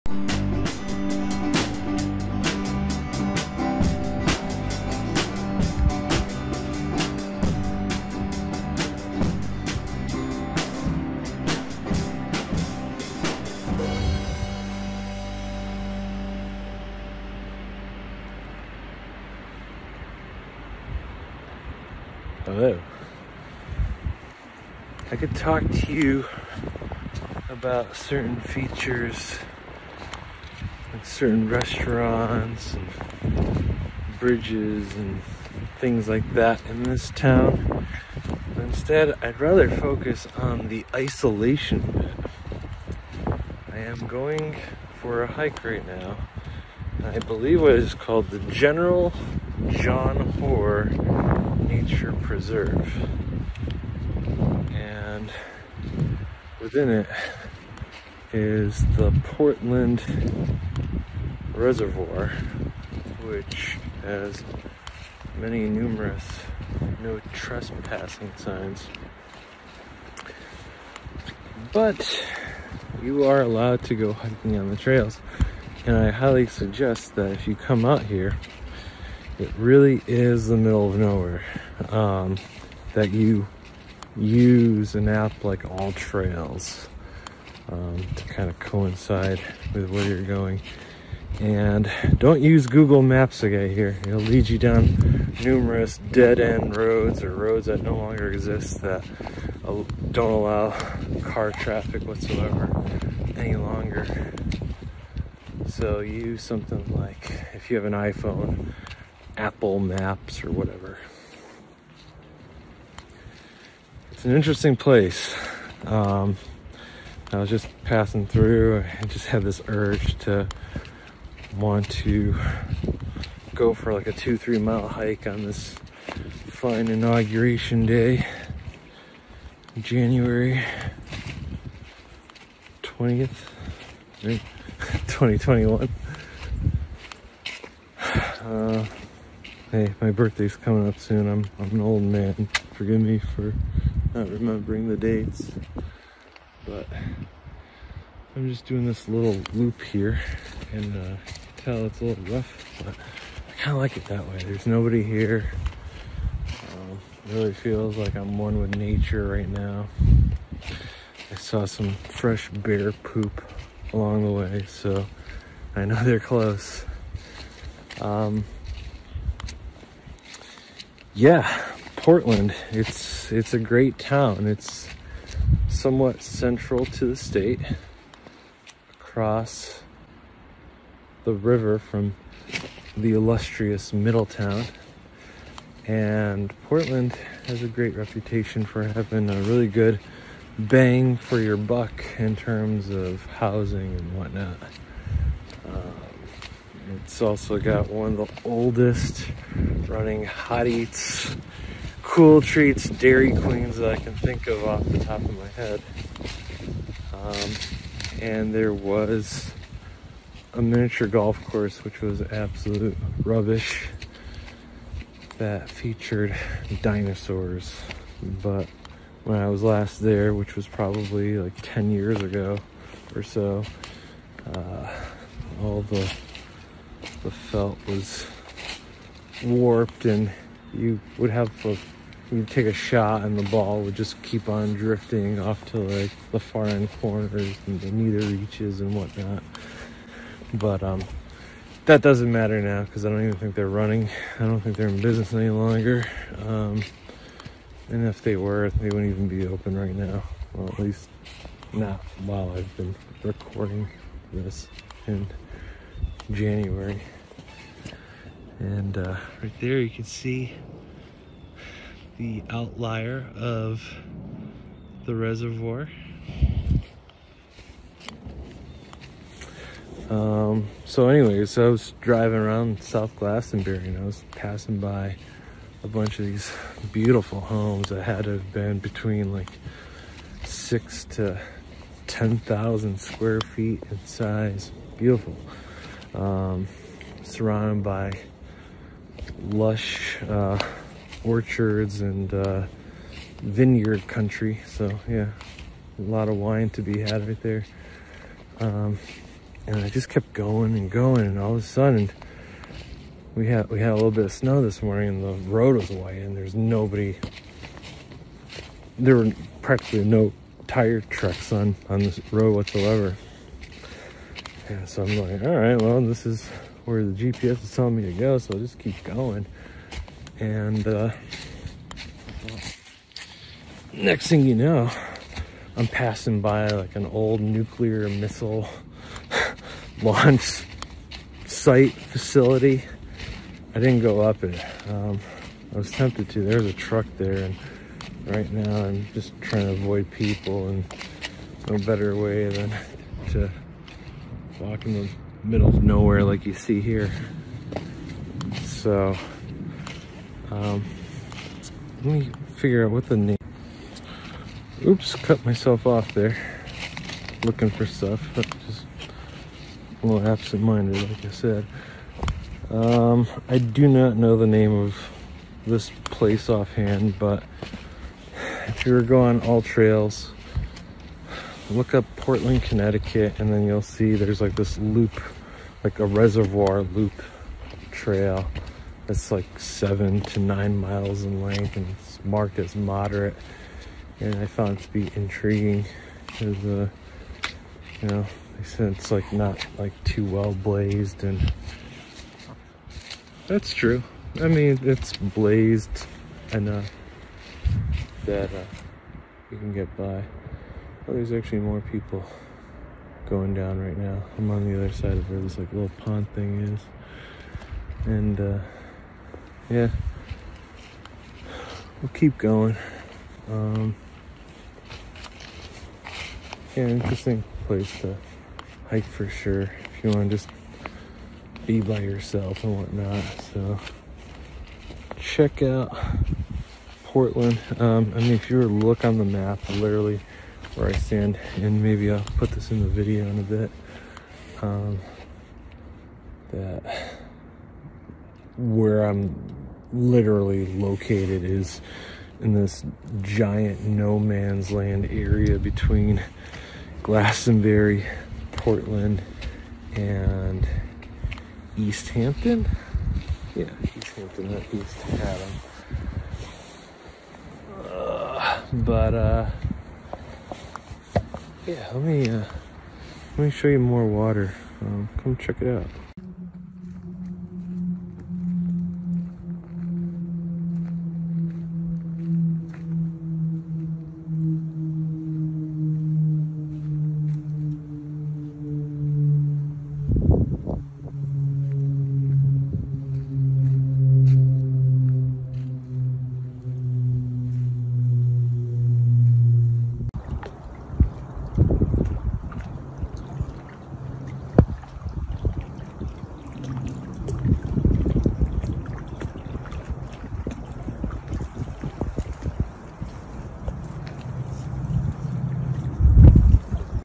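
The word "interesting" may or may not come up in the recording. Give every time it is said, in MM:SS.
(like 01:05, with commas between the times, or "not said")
01:54, 06:56.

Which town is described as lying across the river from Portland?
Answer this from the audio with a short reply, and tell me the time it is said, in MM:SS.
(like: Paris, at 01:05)
Middletown, at 03:03.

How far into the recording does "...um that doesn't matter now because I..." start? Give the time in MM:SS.
04:00.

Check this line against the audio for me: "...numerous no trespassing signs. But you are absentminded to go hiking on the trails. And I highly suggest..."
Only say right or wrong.
wrong.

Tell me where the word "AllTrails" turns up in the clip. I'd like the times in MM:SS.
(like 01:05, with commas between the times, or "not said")
01:25, 06:09.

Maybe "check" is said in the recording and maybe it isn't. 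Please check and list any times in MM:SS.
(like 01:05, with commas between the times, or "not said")
07:05, 07:45.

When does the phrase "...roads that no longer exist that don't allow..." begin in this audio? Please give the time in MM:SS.
01:37.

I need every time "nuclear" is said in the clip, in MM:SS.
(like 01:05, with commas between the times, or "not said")
05:27.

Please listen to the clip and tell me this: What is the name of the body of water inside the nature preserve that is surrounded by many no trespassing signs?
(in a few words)
Portland Reservoir.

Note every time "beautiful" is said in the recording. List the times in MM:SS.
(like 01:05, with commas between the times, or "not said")
04:36, 04:44.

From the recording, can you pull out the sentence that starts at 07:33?
Yeah, East Hampton, not East Haddam.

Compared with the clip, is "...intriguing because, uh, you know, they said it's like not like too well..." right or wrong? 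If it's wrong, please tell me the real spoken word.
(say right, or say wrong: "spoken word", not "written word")
right.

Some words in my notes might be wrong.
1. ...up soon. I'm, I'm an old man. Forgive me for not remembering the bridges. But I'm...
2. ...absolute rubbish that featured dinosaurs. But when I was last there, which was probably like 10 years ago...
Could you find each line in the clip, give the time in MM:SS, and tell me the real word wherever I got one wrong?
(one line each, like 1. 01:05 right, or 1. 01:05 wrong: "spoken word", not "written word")
1. 02:20 wrong: "dates", not "bridges"
2. 03:32 right.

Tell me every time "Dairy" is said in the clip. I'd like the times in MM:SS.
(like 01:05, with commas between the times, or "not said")
03:22.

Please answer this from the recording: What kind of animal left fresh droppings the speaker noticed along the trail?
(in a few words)
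Bear.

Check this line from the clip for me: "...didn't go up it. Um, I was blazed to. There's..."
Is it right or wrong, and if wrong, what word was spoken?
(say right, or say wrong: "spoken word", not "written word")
wrong: "tempted", not "blazed".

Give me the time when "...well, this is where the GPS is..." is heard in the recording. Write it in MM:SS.
05:15.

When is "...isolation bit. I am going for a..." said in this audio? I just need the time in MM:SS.
00:40.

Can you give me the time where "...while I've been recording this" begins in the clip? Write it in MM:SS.
04:12.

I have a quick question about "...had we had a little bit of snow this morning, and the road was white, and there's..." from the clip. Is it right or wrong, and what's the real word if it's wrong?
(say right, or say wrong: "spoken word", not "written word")
right.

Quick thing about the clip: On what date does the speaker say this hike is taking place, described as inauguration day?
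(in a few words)
January 20th, 2021.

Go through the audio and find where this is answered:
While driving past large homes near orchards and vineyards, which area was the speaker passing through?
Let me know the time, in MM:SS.
04:32.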